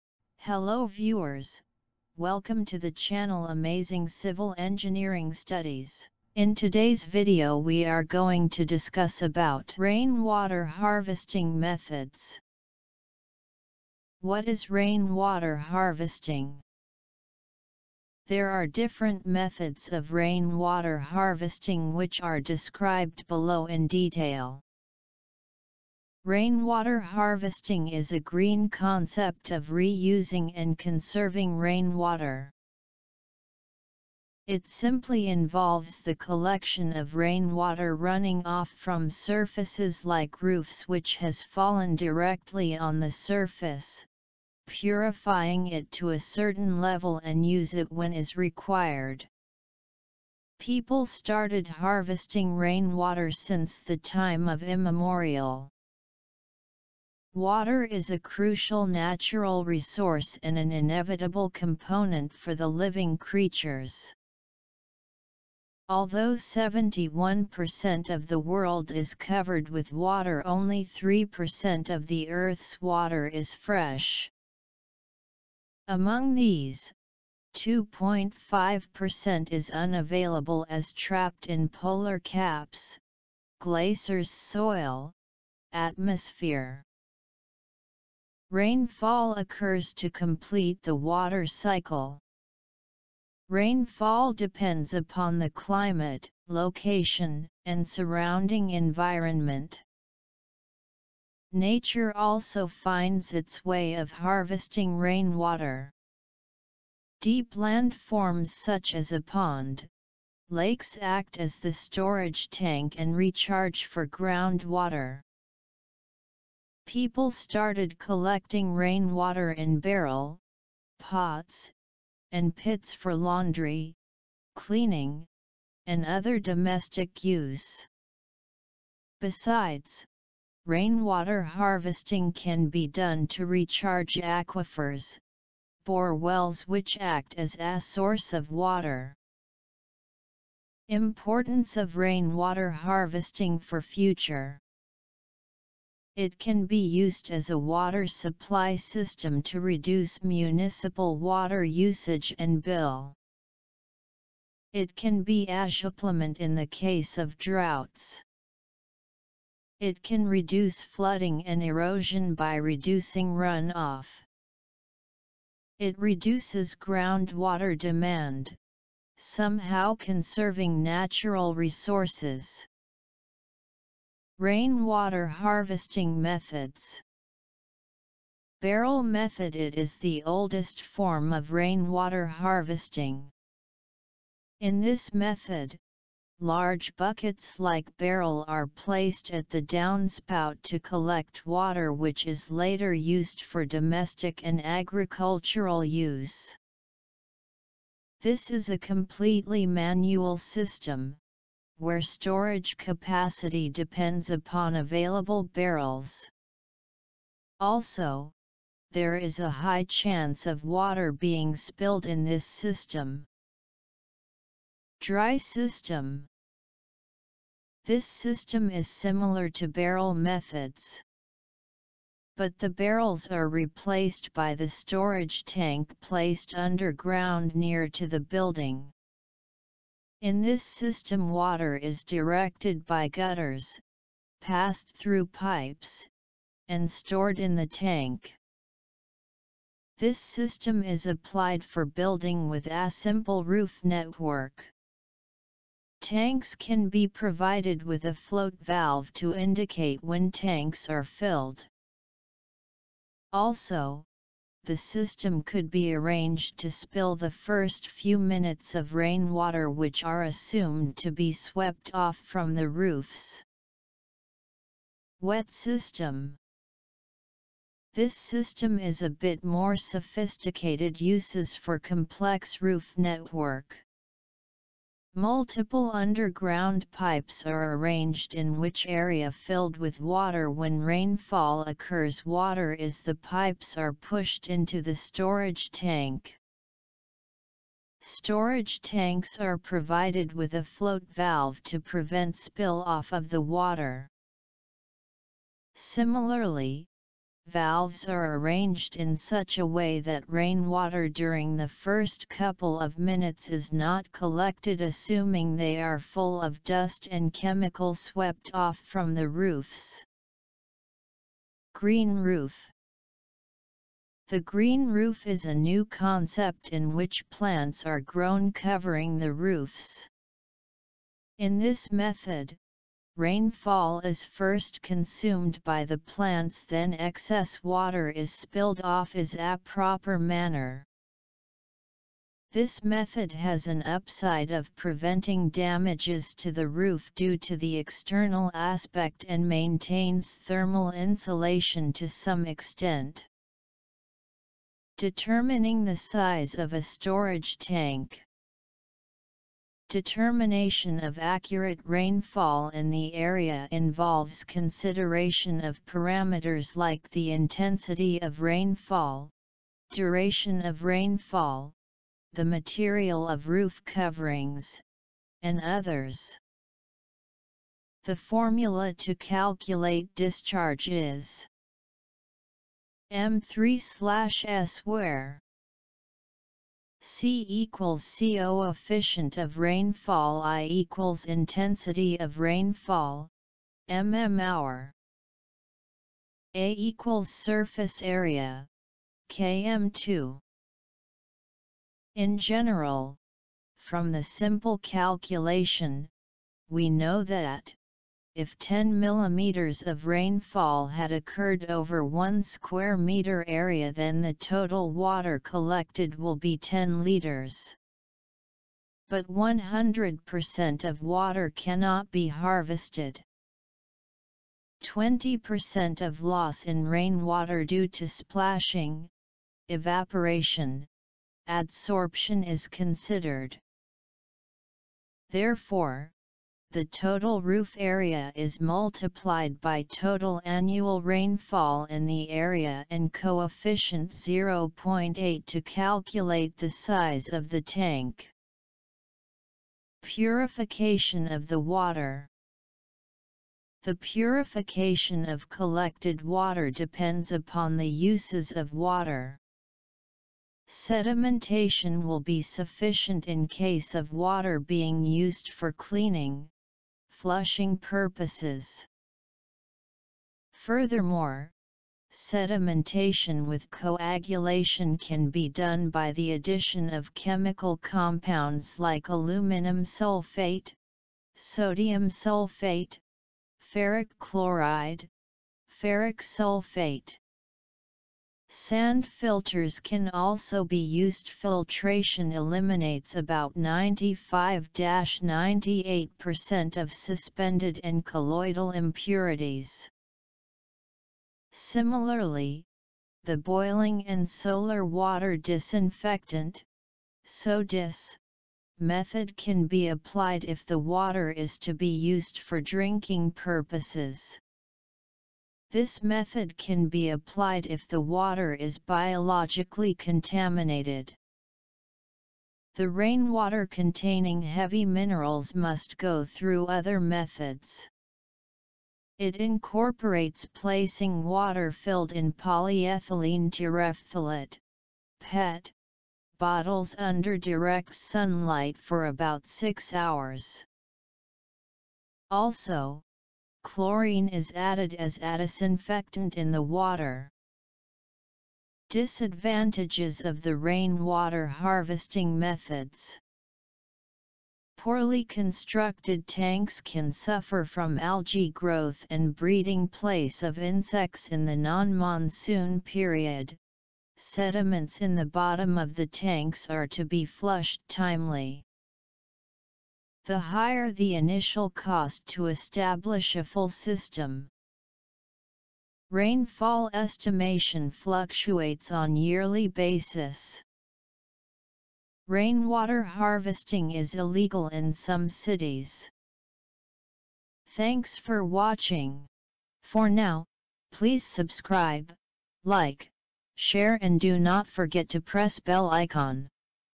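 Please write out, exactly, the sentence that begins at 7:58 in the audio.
Sand filters can also be used.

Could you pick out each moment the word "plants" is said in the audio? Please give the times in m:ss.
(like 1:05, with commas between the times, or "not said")
5:17, 5:25.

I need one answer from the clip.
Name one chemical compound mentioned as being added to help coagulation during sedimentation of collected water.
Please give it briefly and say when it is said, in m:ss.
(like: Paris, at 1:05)
aluminum sulfate, at 7:49.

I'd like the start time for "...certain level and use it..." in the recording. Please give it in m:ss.
0:46.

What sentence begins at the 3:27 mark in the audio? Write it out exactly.
Also, there is a high chance of water being spilled in this system.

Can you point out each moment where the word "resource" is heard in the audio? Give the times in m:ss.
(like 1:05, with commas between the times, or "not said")
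0:59, 2:51.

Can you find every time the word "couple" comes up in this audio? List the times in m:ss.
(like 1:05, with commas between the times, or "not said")
5:02.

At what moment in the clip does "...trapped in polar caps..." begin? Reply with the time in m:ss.
1:20.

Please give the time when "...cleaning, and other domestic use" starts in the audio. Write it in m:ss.
2:04.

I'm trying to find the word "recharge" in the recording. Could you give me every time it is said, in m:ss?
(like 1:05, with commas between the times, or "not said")
1:53, 2:13.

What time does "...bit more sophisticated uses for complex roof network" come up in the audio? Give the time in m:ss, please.
4:29.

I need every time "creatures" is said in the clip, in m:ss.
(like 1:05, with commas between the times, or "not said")
1:03.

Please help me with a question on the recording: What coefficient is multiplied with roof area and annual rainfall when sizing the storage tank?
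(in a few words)
0.8.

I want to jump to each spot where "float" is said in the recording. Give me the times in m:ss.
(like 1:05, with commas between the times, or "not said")
4:08, 4:50.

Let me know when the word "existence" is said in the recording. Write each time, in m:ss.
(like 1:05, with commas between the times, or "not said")
not said.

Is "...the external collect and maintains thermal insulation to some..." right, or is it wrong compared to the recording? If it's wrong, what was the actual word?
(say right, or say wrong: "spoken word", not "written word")
wrong: "aspect", not "collect".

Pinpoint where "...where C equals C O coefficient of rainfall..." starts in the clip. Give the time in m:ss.
6:14.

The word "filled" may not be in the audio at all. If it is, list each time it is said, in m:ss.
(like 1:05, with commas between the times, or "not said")
4:11, 4:39, 8:41.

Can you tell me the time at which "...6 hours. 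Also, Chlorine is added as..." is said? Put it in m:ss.
8:49.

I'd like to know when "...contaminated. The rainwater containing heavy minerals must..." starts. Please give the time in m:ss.
8:29.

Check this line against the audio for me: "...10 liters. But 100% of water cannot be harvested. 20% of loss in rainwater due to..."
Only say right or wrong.
right.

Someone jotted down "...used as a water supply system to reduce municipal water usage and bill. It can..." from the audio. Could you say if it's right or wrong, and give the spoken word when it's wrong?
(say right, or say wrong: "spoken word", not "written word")
right.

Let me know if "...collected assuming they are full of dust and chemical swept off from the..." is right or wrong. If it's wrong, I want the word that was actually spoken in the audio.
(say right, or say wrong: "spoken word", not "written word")
right.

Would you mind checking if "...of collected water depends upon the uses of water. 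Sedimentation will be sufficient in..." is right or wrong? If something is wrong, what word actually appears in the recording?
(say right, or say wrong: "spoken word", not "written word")
right.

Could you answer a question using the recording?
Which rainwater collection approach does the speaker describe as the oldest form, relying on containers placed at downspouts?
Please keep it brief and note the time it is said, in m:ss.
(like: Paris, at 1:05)
Barrel method, at 2:58.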